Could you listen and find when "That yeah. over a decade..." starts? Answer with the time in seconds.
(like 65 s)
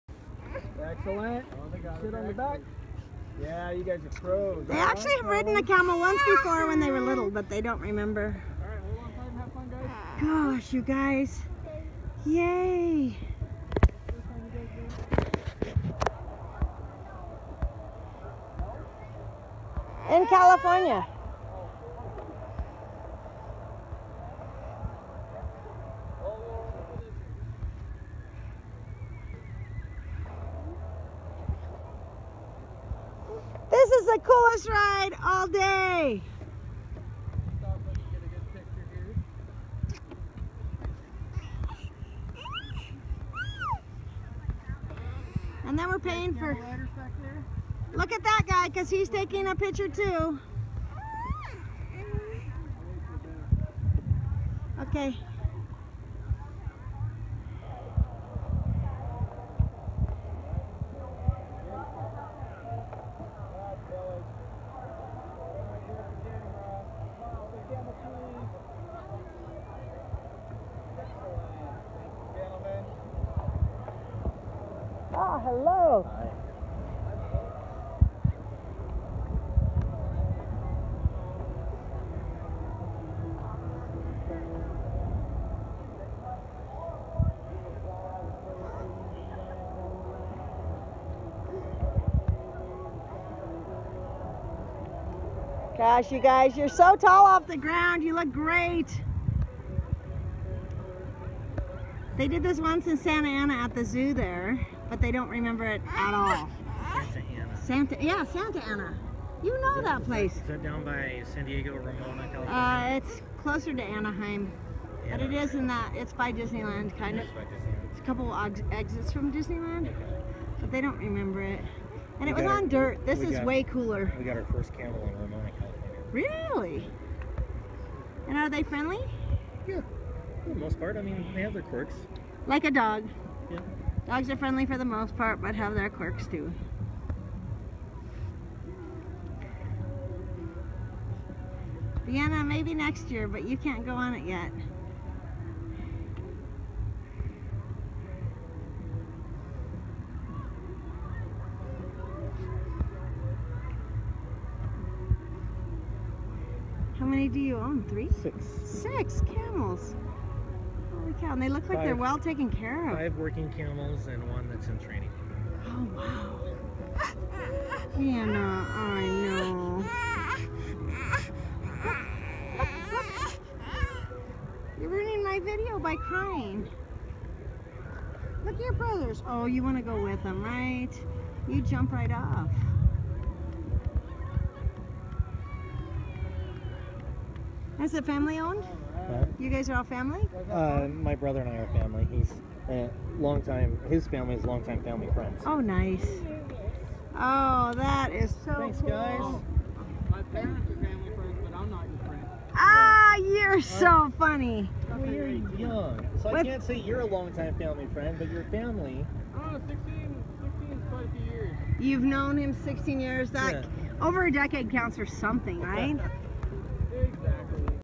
213 s.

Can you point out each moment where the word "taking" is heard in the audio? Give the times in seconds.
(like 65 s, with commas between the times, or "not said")
49 s.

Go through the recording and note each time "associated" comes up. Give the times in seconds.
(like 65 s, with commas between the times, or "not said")
not said.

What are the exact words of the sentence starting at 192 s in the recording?
He's a long time, his family is long time family friends.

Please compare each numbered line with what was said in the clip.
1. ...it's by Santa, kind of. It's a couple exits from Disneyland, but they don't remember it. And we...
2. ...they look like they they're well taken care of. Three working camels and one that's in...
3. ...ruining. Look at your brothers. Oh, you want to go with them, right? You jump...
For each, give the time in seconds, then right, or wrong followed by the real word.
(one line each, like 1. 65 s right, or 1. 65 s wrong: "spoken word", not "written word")
1. 115 s wrong: "Disneyland", not "Santa"
2. 161 s wrong: "Five", not "Three"
3. 175 s wrong: "crying", not "ruining".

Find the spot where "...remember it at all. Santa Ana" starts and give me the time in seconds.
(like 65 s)
105 s.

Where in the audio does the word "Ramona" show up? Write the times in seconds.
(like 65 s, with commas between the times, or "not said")
111 s, 125 s.